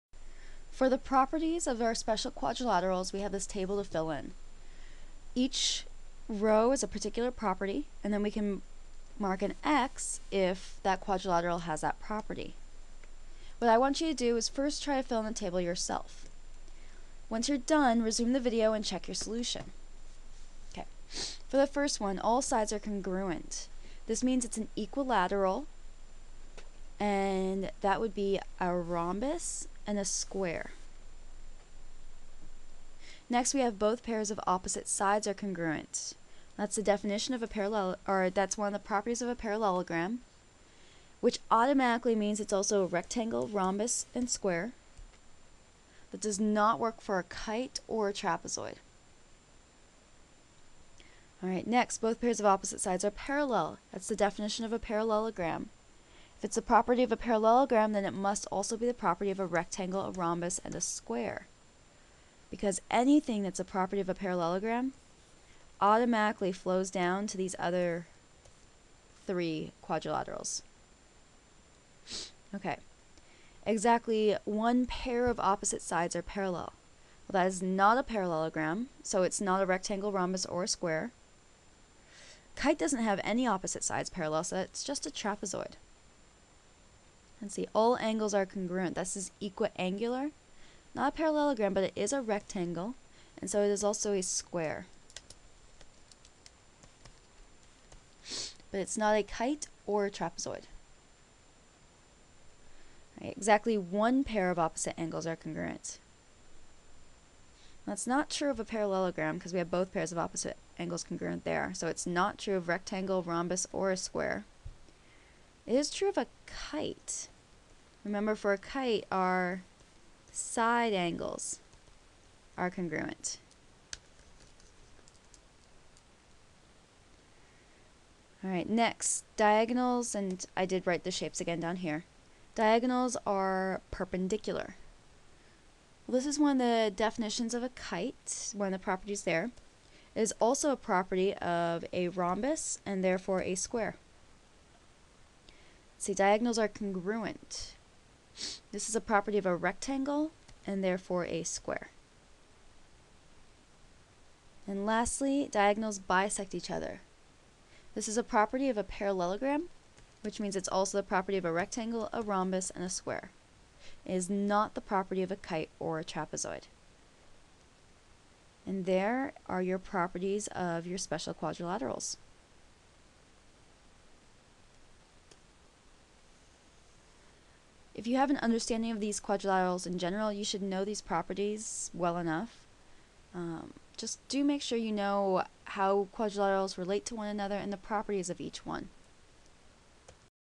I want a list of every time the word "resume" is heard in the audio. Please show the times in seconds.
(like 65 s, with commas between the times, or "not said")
18 s.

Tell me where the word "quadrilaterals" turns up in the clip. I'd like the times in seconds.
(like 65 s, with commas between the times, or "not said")
2 s, 10 s, 69 s, 171 s, 179 s, 186 s.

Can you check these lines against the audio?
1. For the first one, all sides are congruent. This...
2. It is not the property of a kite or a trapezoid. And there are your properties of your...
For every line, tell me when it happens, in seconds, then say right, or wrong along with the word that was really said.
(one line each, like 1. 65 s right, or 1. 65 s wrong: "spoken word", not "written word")
1. 21 s right
2. 164 s right.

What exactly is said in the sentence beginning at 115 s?
It is true of a kite remember for a kite, our side angles are congruent.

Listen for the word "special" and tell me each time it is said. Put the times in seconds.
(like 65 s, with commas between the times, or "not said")
1 s, 170 s.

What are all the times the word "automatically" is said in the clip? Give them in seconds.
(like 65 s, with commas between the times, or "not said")
41 s, 65 s.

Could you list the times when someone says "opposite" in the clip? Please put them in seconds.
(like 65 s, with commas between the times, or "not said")
34 s, 52 s, 75 s, 83 s, 104 s, 110 s.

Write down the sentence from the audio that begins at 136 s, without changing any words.
Well, this is one of the definitions of a kite, one of the properties there.